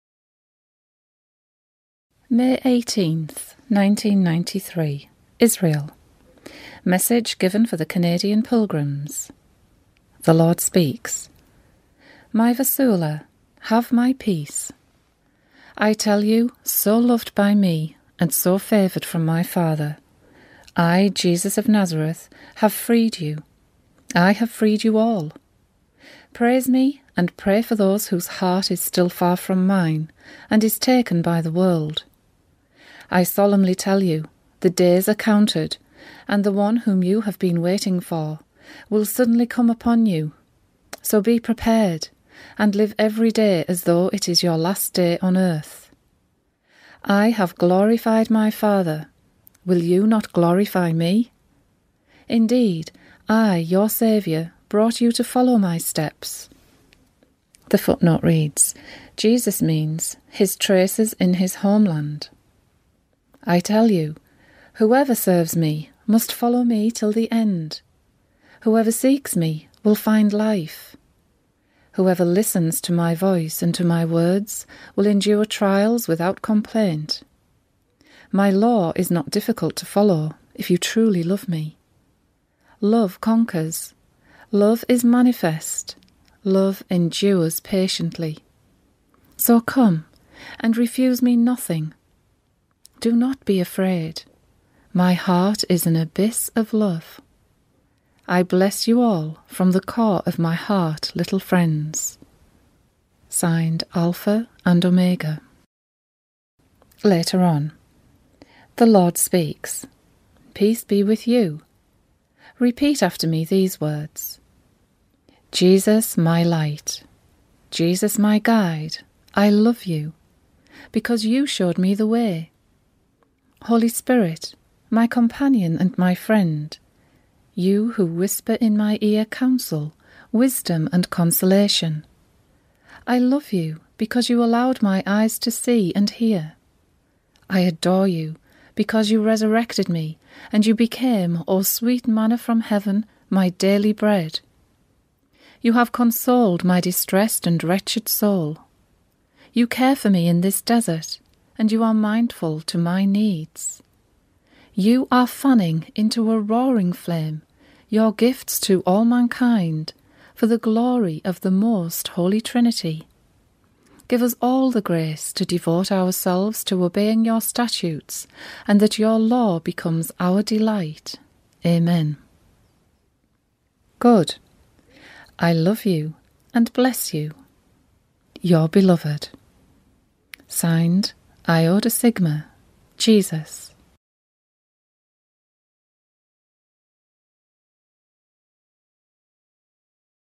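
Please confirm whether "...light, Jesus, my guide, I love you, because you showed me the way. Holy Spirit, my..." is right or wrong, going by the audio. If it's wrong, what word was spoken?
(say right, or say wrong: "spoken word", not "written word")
right.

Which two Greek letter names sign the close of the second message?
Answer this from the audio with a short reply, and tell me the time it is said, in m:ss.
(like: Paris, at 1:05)
Iota Sigma, at 3:01.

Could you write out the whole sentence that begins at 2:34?
You are fanning into a roaring flame your gifts to all mankind for the glory of the most holy Trinity.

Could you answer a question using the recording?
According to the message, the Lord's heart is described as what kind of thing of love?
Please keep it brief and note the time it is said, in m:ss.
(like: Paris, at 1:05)
An abyss, at 1:35.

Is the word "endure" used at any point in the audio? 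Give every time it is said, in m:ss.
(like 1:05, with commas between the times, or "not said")
1:15, 1:26.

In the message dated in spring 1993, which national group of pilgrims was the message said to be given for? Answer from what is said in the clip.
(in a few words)
Canadian.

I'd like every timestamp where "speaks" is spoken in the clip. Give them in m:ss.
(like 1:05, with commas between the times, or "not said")
0:10, 1:49.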